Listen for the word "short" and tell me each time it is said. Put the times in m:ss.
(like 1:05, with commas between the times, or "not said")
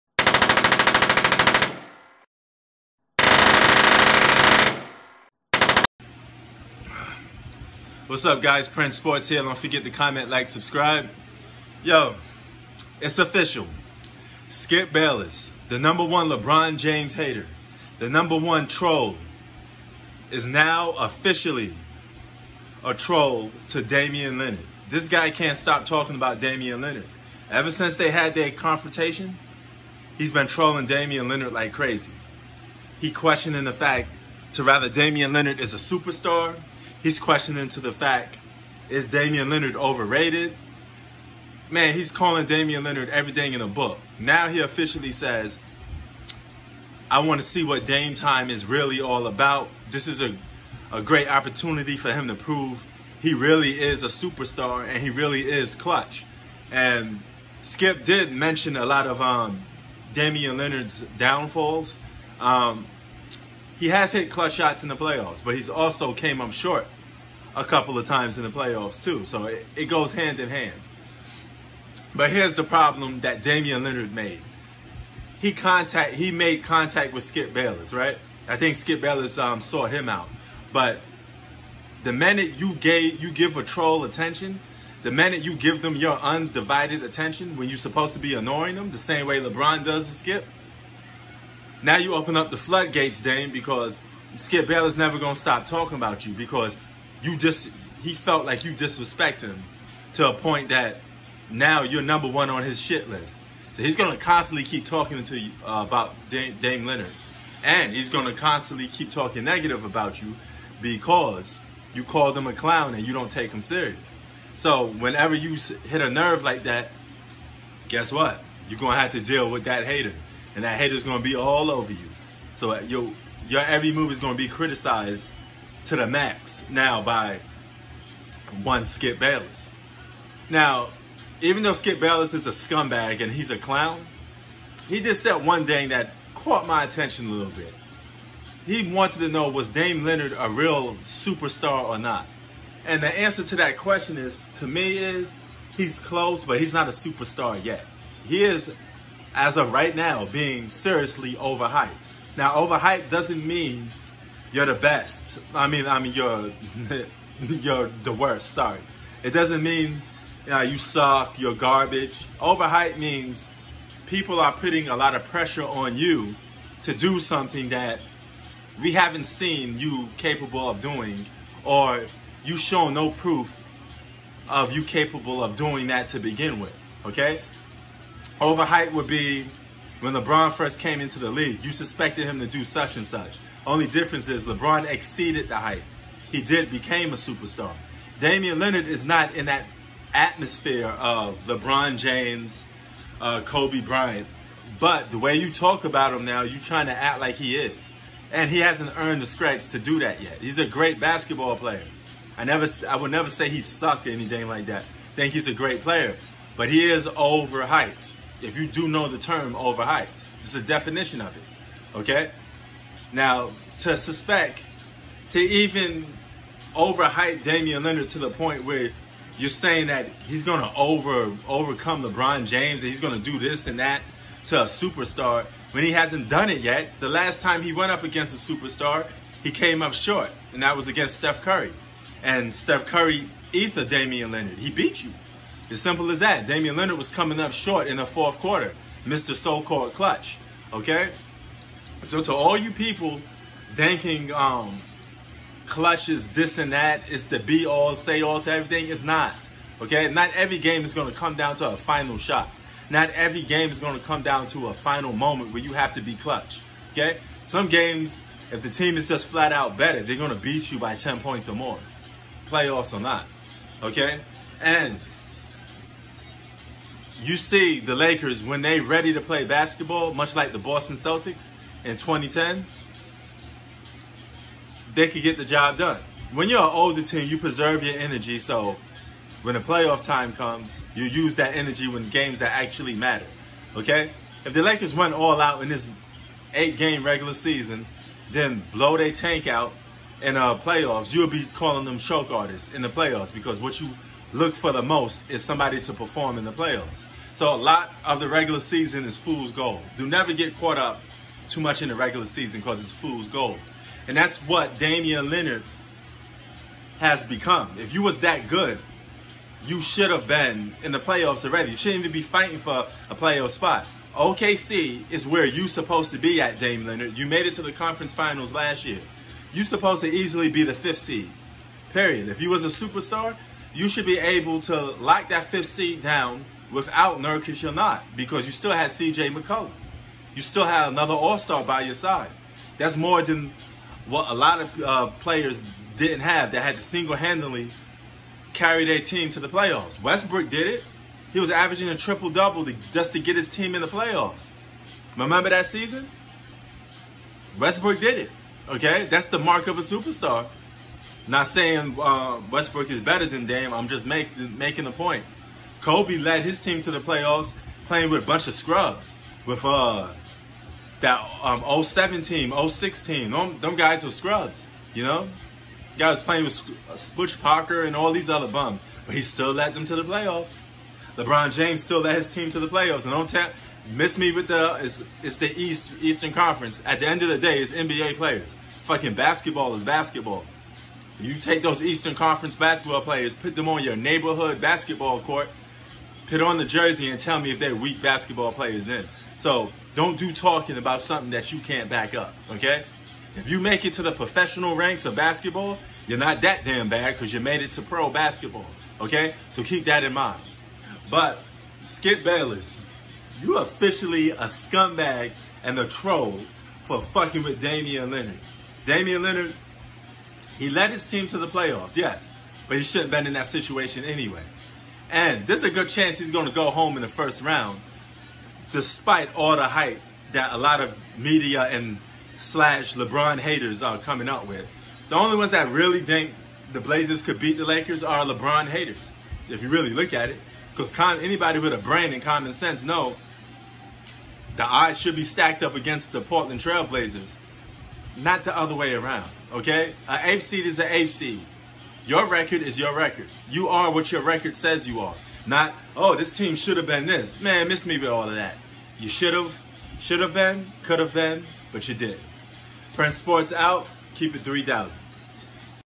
1:06, 3:49, 3:57.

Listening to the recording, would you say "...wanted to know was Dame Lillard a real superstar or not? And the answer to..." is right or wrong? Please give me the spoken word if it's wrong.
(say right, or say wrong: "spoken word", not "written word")
right.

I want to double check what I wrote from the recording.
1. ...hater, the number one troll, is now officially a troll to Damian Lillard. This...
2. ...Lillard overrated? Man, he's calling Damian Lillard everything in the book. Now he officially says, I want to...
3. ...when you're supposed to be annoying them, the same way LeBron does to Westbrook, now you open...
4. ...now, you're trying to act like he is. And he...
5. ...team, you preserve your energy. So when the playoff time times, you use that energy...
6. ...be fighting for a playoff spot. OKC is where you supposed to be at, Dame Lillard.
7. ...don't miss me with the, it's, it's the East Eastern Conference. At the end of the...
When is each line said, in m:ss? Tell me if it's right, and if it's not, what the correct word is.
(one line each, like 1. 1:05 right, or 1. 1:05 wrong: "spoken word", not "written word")
1. 0:17 right
2. 0:39 right
3. 1:27 wrong: "Skip", not "Westbrook"
4. 3:16 right
5. 4:37 wrong: "comes", not "times"
6. 5:12 right
7. 6:13 right.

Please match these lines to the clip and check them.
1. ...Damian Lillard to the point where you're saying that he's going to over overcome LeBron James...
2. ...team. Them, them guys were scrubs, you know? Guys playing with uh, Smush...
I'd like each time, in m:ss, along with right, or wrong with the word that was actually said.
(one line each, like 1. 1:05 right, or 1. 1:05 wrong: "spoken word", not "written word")
1. 3:37 right
2. 6:03 right.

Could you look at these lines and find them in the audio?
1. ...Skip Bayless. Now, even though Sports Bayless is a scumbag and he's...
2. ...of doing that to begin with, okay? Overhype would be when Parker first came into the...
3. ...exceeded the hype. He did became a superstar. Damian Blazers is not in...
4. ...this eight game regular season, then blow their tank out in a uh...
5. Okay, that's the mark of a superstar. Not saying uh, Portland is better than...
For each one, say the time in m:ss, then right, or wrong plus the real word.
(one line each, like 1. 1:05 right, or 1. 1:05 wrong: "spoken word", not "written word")
1. 2:08 wrong: "Skip", not "Sports"
2. 2:55 wrong: "LeBron", not "Parker"
3. 3:04 wrong: "Lillard", not "Blazers"
4. 4:45 right
5. 5:48 wrong: "Westbrook", not "Portland".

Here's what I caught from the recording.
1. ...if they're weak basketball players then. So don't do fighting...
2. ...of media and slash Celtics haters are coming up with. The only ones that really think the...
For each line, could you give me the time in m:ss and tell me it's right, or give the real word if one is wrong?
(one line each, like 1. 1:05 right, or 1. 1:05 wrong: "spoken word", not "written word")
1. 6:27 wrong: "talking", not "fighting"
2. 7:00 wrong: "LeBron", not "Celtics".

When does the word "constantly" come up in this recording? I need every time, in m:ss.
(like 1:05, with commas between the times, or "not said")
1:44, 1:48.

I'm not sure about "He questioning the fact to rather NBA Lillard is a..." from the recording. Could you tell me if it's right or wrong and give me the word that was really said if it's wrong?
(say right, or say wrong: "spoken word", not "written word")
wrong: "Damian", not "NBA".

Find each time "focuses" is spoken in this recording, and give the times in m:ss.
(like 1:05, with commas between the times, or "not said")
not said.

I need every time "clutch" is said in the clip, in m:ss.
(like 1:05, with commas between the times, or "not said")
0:55, 1:04, 3:59, 4:05, 4:16.